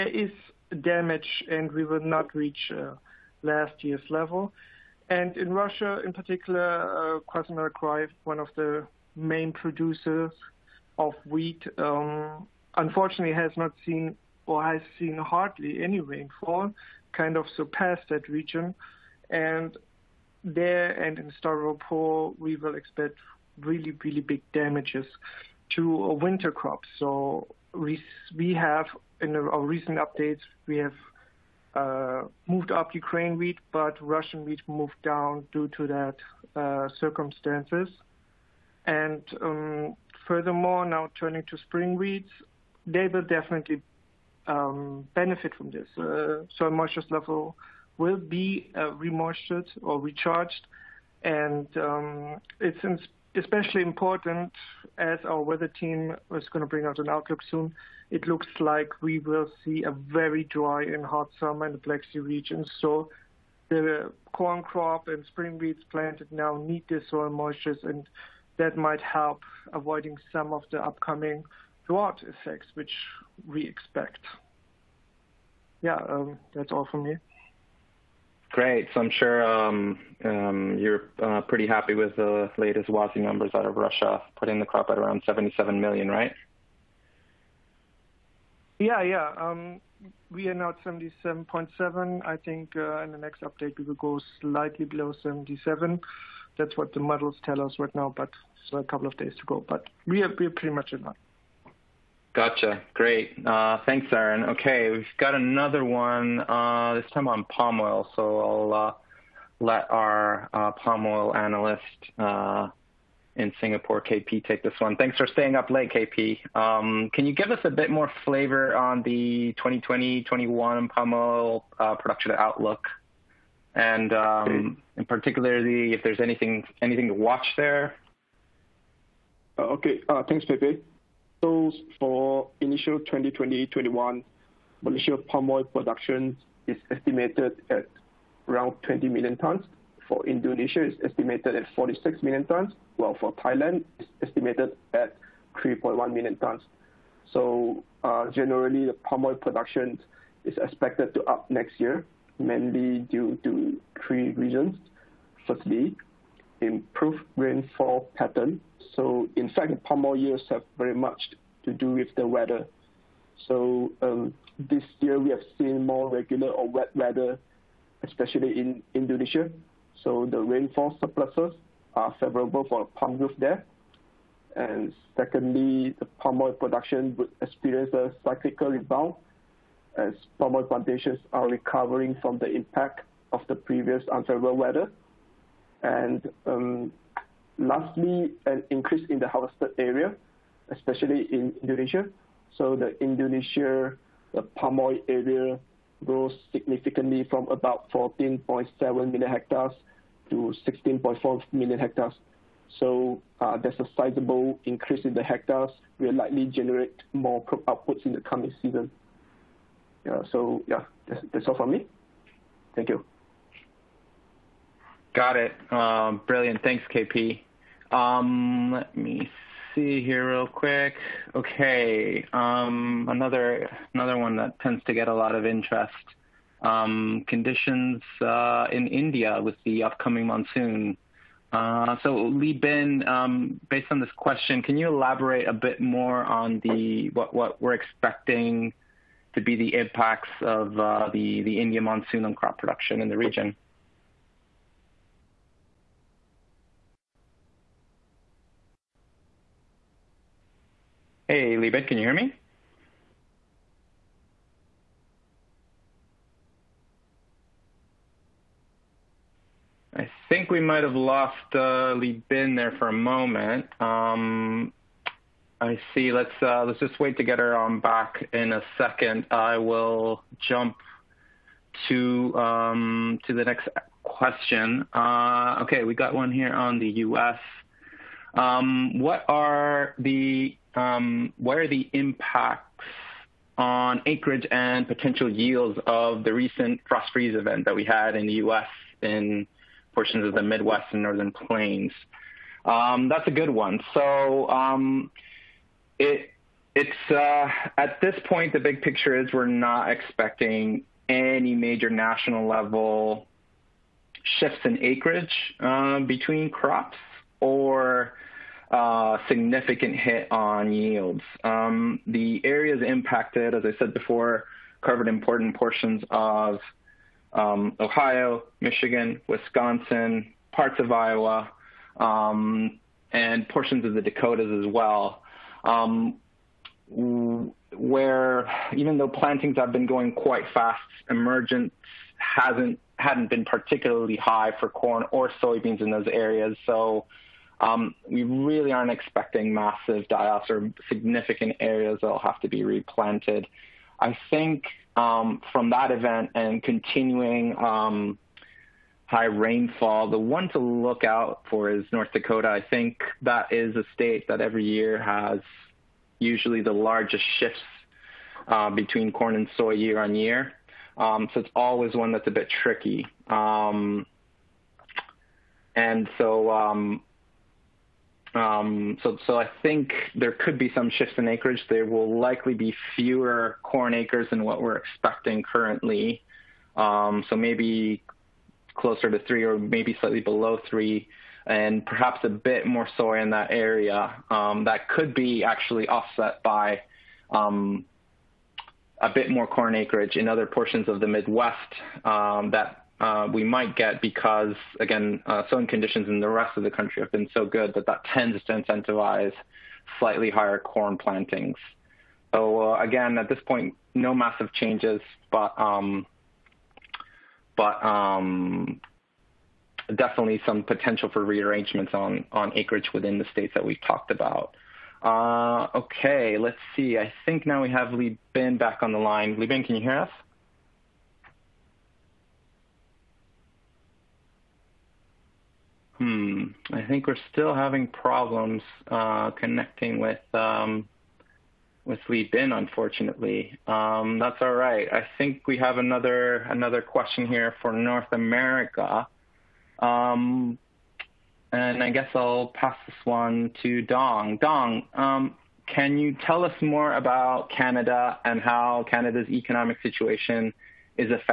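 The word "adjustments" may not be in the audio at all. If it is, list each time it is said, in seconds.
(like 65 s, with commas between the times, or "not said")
not said.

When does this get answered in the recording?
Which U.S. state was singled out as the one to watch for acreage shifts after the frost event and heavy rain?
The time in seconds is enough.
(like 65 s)
351 s.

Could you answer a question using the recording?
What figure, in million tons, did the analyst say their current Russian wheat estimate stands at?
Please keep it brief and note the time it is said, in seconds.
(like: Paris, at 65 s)
77.7, at 90 s.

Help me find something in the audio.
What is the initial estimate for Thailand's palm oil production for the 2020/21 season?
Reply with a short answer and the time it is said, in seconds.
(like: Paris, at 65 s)
3.1 million tons, at 145 s.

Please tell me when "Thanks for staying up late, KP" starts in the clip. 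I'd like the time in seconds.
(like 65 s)
114 s.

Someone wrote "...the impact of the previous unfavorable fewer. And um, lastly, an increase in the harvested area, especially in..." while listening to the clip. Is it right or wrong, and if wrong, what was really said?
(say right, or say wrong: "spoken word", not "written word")
wrong: "weather", not "fewer".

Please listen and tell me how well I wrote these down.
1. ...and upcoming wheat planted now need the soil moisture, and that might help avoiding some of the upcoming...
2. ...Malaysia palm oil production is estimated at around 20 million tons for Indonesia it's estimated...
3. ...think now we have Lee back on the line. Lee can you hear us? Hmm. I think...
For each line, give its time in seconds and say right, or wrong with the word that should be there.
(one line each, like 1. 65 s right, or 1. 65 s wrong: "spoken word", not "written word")
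1. 65 s wrong: "spring", not "upcoming"
2. 134 s right
3. 417 s right.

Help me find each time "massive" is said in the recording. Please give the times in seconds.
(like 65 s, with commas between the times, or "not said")
339 s, 404 s.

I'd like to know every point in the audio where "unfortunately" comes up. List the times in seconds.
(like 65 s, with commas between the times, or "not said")
12 s, 432 s.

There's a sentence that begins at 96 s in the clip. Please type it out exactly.
That's what the models tell us right now, but so a couple of days to go.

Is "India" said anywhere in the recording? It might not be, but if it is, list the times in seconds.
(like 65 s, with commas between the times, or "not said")
228 s, 241 s.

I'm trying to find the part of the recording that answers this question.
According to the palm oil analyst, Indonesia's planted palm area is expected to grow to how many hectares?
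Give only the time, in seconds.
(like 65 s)
200 s.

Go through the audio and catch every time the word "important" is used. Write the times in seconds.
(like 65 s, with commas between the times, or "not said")
53 s, 315 s.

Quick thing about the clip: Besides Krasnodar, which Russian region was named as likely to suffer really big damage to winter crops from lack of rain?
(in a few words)
Stavropol.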